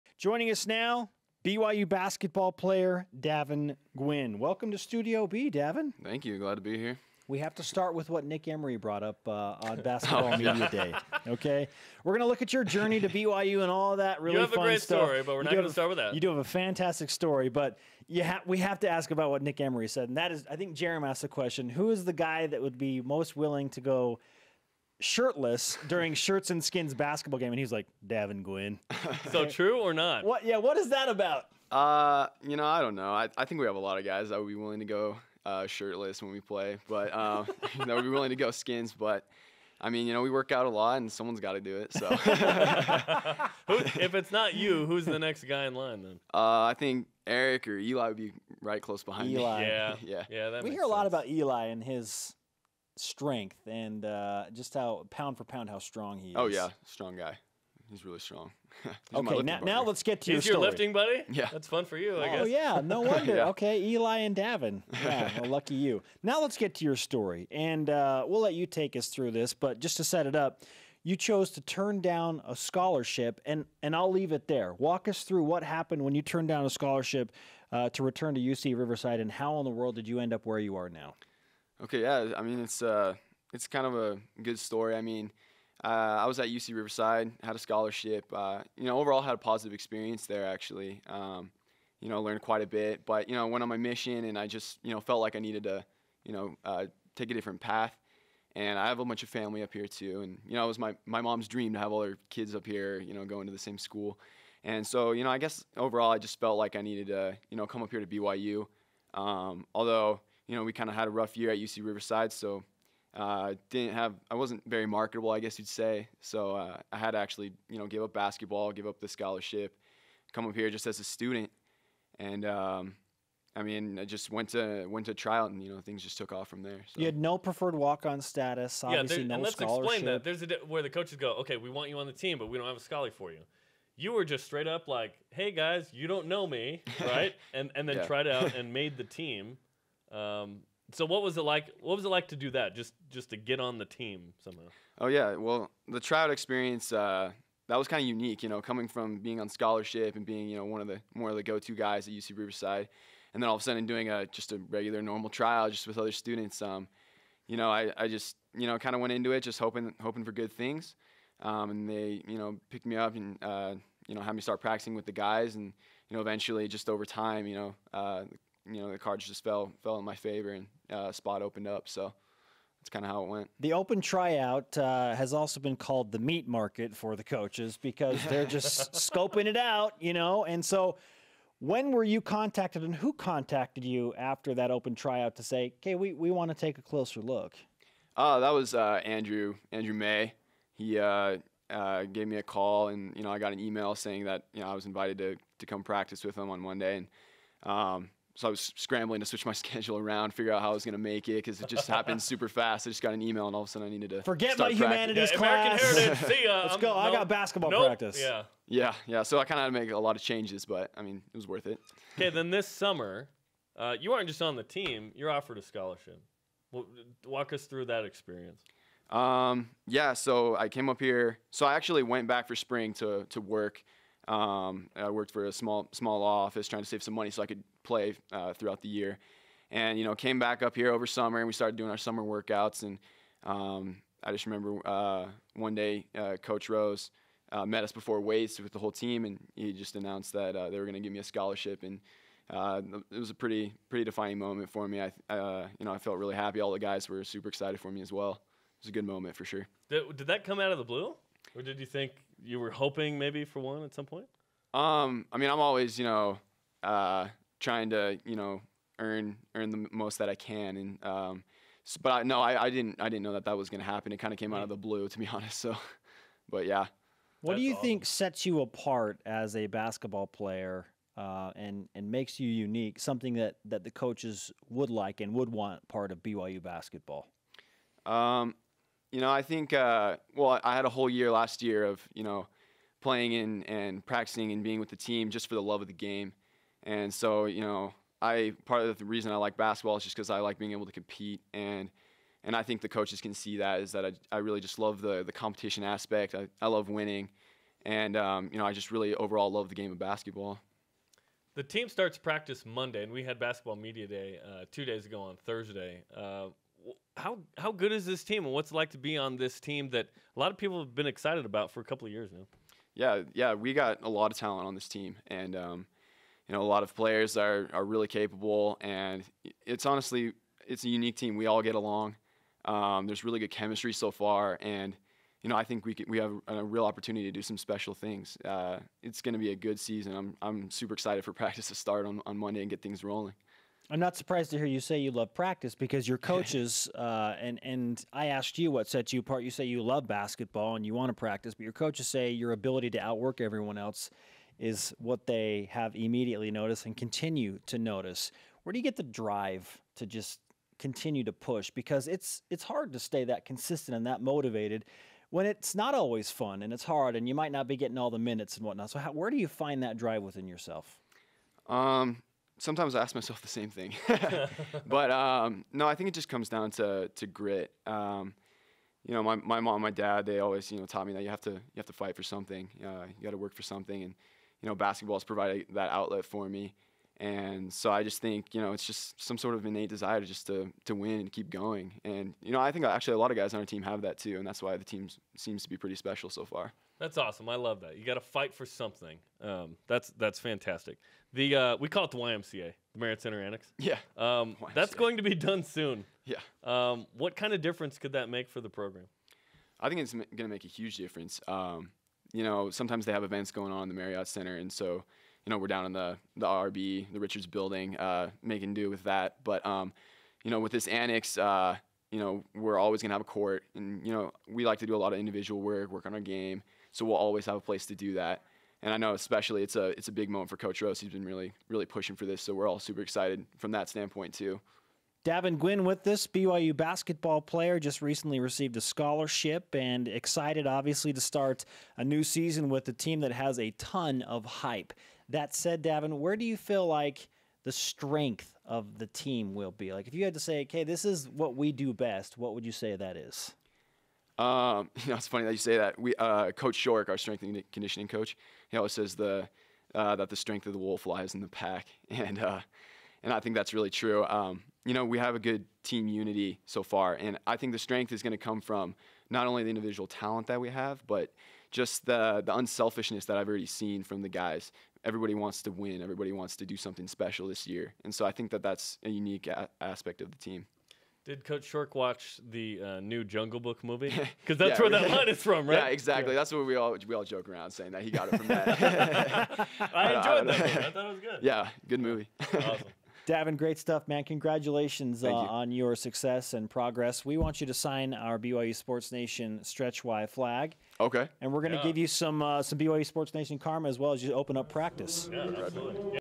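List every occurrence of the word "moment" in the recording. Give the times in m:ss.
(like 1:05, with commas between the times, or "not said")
4:04, 4:09, 7:00.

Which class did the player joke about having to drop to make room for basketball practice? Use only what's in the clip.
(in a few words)
American Heritage.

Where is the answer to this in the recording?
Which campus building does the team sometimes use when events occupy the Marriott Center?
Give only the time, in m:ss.
6:47.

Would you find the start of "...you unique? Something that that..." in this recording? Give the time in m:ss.
4:32.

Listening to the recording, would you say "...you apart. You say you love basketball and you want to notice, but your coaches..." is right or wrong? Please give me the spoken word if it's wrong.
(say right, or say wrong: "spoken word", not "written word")
wrong: "practice", not "notice".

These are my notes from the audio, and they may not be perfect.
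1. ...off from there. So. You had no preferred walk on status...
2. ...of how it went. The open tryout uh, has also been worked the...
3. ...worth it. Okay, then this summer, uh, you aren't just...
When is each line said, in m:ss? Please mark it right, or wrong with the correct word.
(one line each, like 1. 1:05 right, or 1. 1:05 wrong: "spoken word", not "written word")
1. 2:06 right
2. 2:53 wrong: "called", not "worked"
3. 3:31 right.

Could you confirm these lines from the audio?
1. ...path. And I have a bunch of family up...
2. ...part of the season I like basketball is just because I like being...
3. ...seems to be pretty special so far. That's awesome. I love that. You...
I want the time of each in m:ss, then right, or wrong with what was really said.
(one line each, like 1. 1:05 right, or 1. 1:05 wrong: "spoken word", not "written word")
1. 1:37 right
2. 4:48 wrong: "reason", not "season"
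3. 6:25 right.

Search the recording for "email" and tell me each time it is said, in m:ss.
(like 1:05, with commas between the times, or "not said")
3:13, 3:23.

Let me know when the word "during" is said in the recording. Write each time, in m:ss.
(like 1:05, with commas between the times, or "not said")
0:25.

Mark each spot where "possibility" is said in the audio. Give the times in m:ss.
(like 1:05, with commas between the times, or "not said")
not said.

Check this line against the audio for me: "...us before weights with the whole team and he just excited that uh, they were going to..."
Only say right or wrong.
wrong.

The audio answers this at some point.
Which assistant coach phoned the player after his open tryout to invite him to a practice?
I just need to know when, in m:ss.
3:09.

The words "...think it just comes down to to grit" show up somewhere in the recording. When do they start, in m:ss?
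6:05.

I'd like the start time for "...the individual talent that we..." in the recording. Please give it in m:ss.
7:39.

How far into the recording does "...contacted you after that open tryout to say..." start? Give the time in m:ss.
3:03.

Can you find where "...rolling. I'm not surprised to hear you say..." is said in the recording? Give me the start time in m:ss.
5:33.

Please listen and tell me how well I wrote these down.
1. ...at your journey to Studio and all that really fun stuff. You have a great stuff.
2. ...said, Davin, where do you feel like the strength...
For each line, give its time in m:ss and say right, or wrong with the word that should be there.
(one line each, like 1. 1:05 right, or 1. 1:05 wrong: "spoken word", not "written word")
1. 0:12 wrong: "BYU", not "Studio"
2. 7:15 right.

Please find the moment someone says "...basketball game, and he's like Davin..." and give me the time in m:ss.
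0:26.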